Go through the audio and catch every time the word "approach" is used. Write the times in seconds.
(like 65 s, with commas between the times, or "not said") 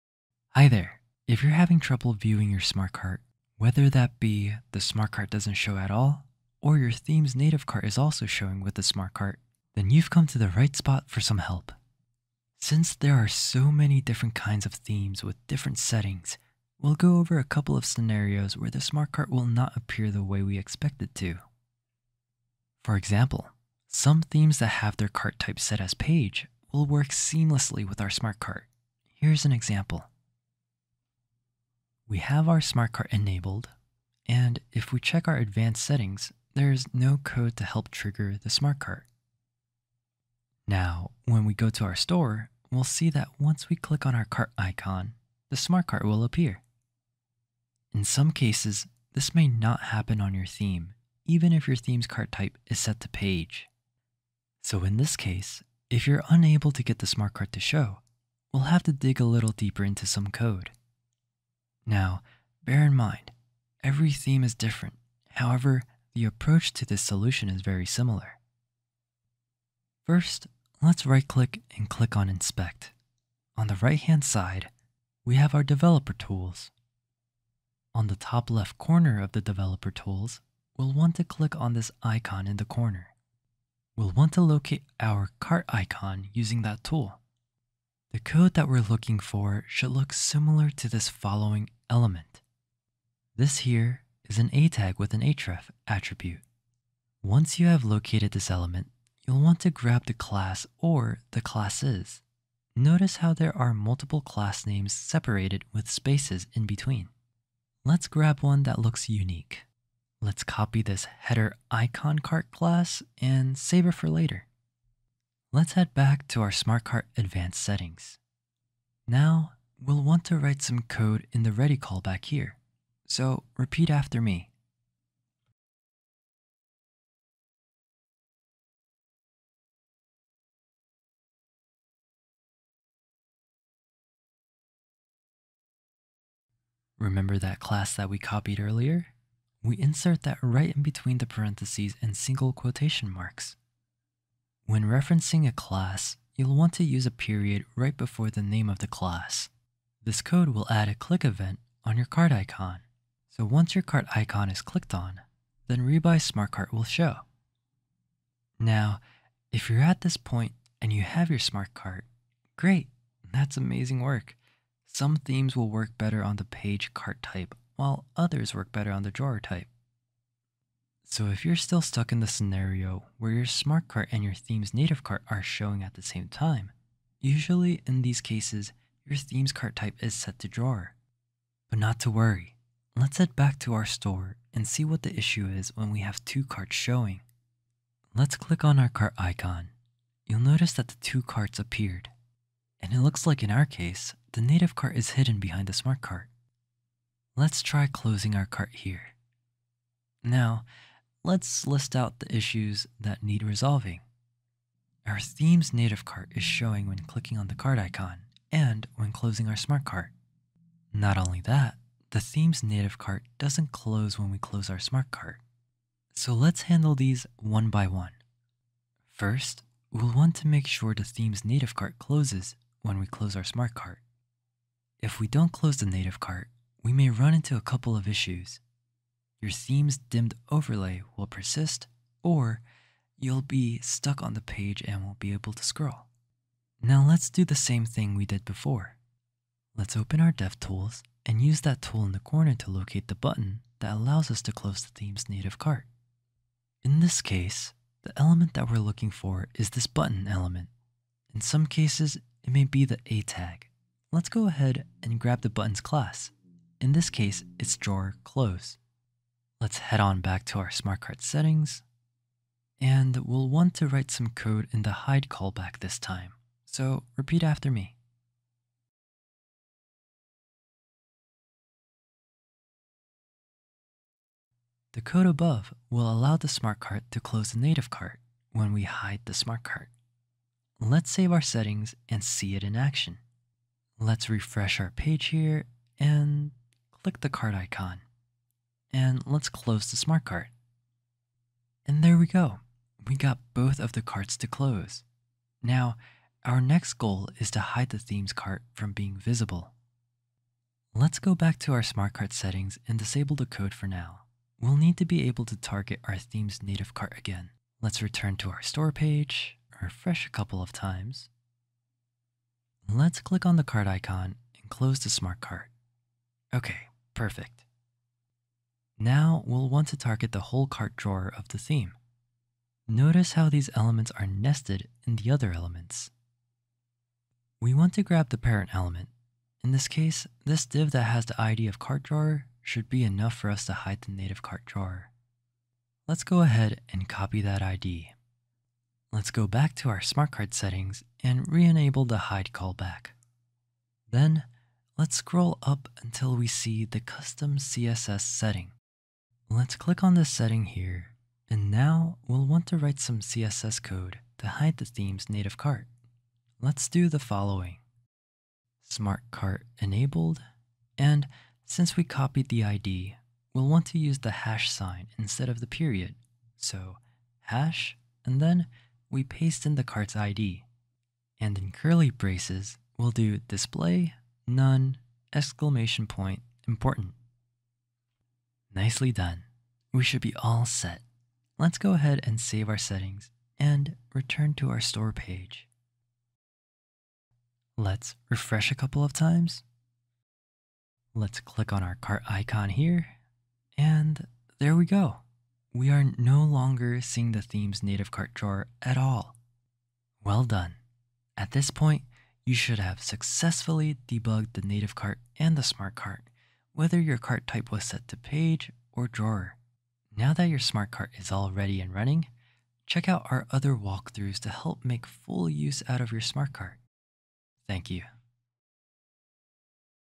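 66 s.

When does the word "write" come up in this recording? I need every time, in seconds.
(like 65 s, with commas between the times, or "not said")
120 s, 263 s, 352 s.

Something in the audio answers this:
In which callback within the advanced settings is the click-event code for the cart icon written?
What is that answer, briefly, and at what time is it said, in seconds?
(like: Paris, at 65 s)
ready call back, at 121 s.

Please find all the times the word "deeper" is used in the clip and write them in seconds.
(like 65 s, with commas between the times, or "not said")
59 s.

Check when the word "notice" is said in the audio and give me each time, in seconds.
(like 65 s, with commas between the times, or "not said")
102 s, 190 s, 322 s.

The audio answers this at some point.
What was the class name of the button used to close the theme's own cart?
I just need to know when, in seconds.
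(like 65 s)
257 s.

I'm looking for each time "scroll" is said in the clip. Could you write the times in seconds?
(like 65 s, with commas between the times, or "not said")
235 s, 345 s.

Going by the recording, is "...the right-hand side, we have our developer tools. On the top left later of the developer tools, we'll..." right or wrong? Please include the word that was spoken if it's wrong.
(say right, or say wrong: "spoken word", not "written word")
wrong: "corner", not "later".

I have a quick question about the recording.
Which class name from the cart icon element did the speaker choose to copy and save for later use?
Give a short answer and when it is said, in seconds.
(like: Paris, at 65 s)
header icon cart, at 111 s.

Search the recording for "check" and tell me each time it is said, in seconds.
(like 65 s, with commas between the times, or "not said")
34 s, 412 s.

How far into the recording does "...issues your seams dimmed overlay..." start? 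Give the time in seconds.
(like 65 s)
228 s.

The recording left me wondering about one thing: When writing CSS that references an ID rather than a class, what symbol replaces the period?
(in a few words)
hash sign.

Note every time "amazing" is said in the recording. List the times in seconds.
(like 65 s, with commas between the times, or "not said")
163 s.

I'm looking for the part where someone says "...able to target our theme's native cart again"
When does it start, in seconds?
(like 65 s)
305 s.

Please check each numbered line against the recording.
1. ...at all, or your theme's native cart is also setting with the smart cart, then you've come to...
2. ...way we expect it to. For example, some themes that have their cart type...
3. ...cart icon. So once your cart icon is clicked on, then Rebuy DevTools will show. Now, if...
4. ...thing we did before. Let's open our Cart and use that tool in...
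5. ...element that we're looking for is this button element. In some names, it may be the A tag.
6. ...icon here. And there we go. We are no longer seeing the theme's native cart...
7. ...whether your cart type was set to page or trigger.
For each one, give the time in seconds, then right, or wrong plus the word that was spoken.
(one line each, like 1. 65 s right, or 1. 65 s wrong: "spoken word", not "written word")
1. 5 s wrong: "showing", not "setting"
2. 20 s right
3. 152 s wrong: "SmartCart", not "DevTools"
4. 237 s wrong: "DevTools", not "Cart"
5. 248 s wrong: "cases", not "names"
6. 392 s right
7. 406 s wrong: "drawer", not "trigger".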